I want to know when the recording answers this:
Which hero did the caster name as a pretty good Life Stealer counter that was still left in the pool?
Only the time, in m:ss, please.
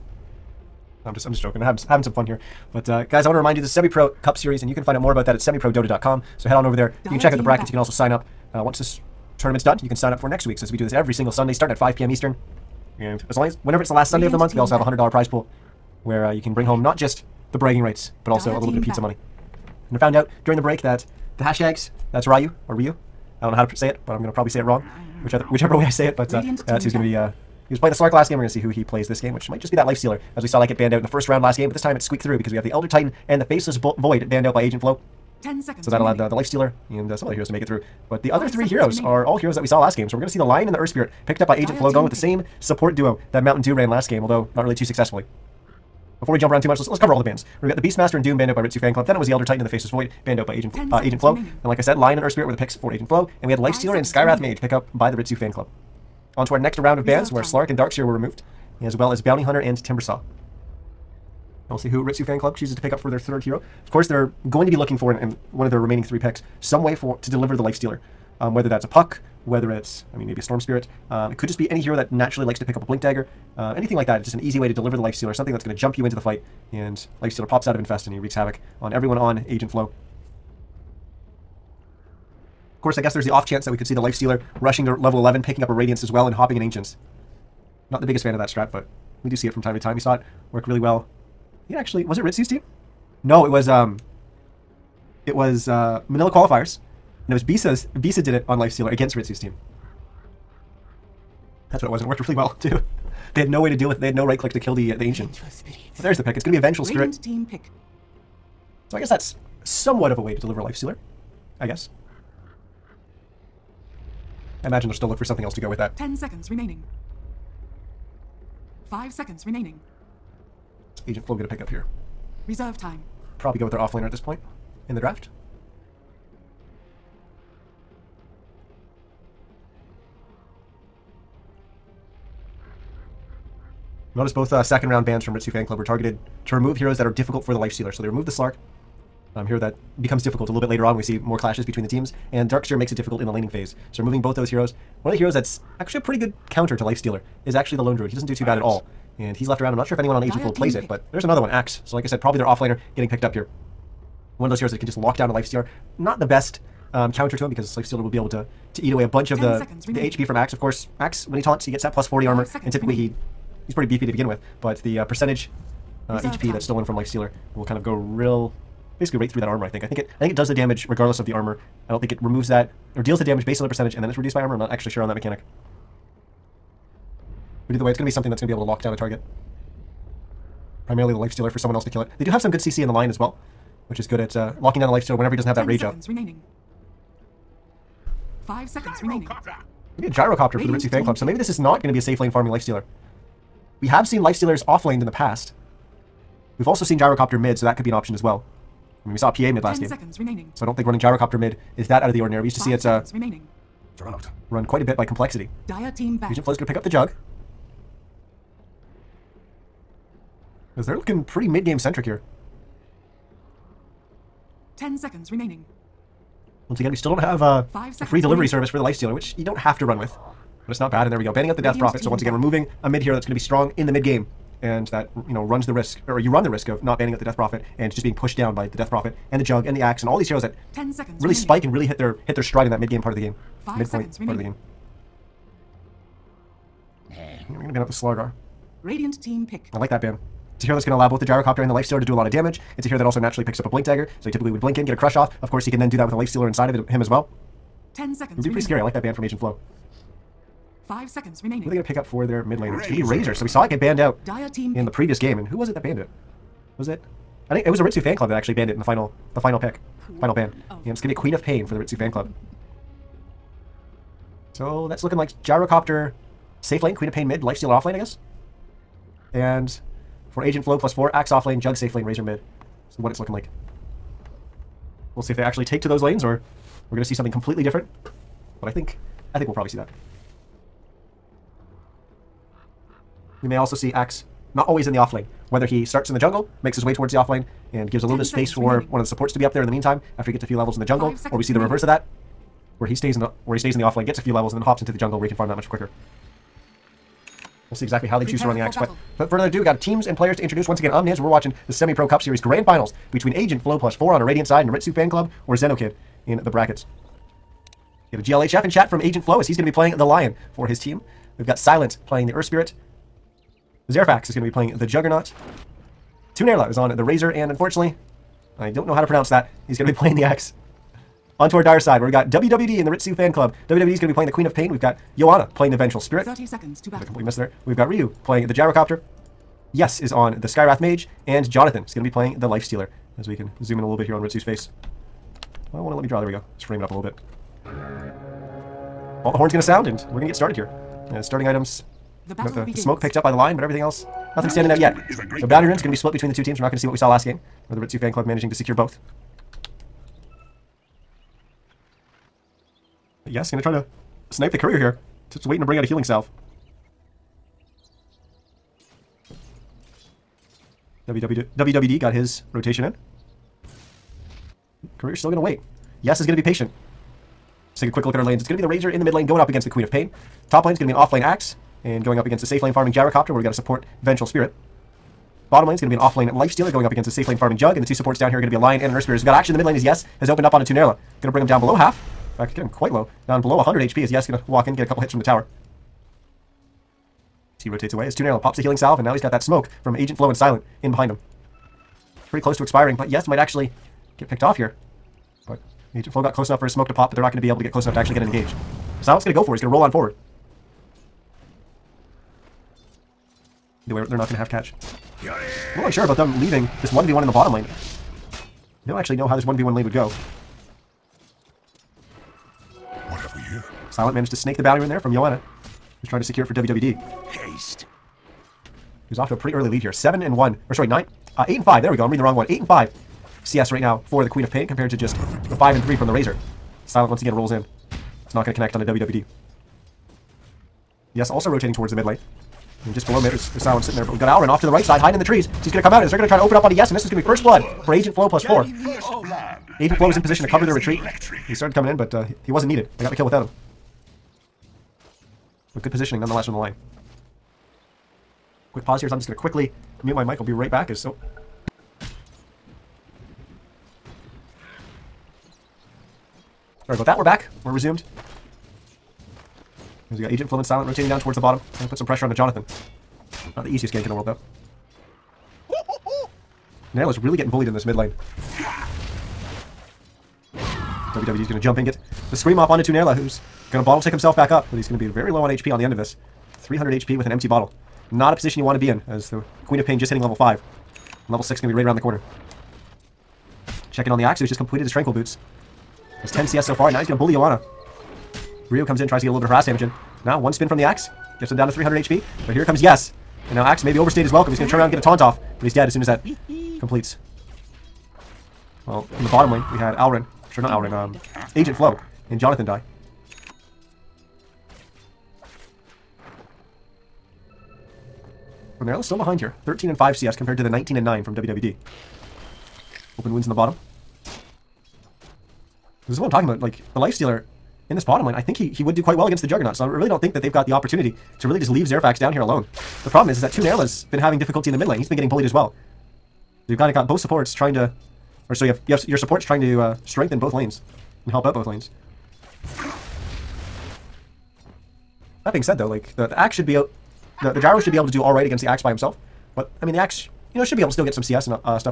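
2:27.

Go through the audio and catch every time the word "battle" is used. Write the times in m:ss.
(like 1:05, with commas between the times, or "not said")
5:26, 5:45.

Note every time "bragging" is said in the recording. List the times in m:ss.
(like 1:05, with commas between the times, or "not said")
0:17.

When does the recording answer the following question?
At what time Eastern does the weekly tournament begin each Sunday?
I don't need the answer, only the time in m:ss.
0:11.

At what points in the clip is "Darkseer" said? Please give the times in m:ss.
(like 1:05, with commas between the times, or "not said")
0:57, 2:22.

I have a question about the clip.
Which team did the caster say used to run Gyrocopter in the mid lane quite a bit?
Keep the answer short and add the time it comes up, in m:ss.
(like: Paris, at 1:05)
Complexity, at 3:25.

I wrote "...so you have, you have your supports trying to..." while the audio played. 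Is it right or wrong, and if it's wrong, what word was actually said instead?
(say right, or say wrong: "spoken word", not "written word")
right.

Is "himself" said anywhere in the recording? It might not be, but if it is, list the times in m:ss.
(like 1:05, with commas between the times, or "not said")
7:54, 8:58.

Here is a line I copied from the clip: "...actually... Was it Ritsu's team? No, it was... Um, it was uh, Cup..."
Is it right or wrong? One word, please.
wrong.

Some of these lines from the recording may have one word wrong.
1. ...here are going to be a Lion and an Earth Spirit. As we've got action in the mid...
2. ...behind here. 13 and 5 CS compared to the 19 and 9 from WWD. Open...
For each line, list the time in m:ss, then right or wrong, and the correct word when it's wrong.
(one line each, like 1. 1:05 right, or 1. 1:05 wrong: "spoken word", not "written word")
1. 6:18 right
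2. 8:29 right.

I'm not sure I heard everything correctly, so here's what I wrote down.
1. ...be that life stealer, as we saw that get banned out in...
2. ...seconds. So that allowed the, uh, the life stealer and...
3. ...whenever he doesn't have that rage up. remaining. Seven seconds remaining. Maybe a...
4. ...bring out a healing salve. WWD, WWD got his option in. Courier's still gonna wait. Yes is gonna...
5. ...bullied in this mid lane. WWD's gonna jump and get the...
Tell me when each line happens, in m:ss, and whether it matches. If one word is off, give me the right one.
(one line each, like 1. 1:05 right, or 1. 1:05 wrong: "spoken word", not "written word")
1. 0:29 right
2. 0:35 right
3. 3:05 wrong: "Five", not "Seven"
4. 5:55 wrong: "rotation", not "option"
5. 7:47 right.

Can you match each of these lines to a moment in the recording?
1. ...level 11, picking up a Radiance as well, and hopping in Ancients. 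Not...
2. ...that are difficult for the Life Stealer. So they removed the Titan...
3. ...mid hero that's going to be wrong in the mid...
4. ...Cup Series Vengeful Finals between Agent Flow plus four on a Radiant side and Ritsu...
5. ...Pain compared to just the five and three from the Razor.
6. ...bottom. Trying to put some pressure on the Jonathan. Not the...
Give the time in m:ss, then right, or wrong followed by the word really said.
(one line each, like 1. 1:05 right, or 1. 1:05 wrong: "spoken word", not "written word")
1. 1:24 right
2. 2:16 wrong: "Slark", not "Titan"
3. 3:42 wrong: "strong", not "wrong"
4. 5:02 wrong: "Grand", not "Vengeful"
5. 7:04 right
6. 7:41 right.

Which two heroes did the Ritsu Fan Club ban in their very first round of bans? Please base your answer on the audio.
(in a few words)
Beastmaster and Doom.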